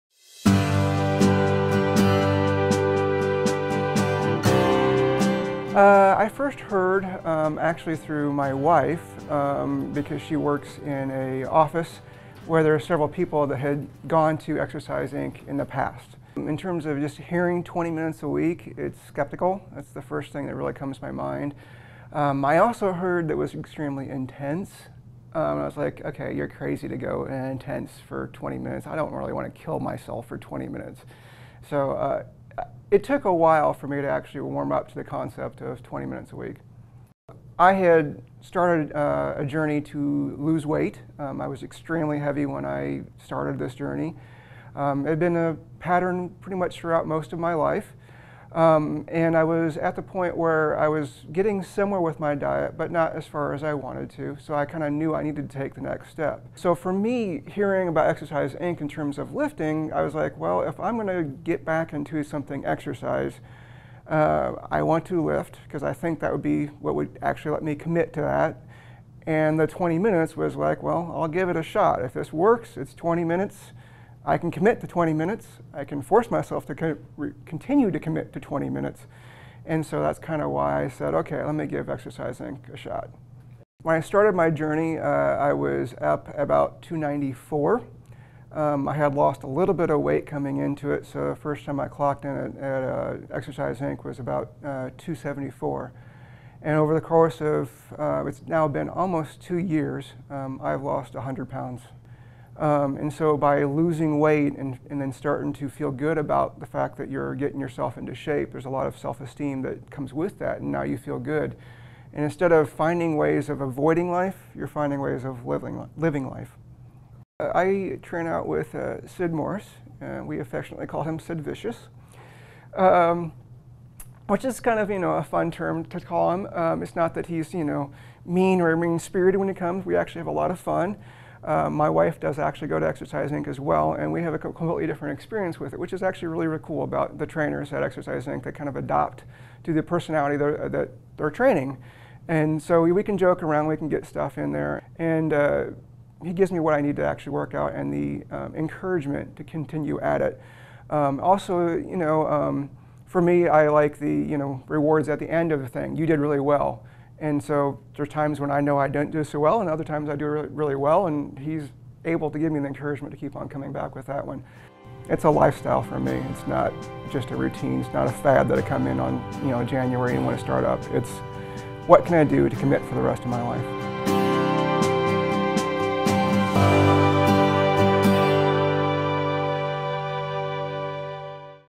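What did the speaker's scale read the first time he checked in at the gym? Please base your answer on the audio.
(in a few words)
274.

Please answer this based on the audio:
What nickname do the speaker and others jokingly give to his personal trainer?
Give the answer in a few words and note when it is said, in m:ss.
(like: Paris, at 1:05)
Sid Vicious, at 2:01.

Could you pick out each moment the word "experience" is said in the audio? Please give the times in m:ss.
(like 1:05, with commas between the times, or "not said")
2:15.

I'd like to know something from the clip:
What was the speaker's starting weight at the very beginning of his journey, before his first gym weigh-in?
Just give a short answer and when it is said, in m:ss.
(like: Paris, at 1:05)
294, at 1:26.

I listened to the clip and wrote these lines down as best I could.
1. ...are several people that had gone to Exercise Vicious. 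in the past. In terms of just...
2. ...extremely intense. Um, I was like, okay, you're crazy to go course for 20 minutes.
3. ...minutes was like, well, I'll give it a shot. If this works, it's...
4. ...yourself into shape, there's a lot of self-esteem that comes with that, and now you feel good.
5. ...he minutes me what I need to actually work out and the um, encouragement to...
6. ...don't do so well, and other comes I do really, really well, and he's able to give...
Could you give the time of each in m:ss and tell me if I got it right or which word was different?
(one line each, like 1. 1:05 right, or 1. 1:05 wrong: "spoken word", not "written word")
1. 0:12 wrong: "Inc", not "Vicious"
2. 0:23 wrong: "intense", not "course"
3. 1:09 right
4. 1:47 right
5. 2:26 wrong: "gives", not "minutes"
6. 2:38 wrong: "times", not "comes".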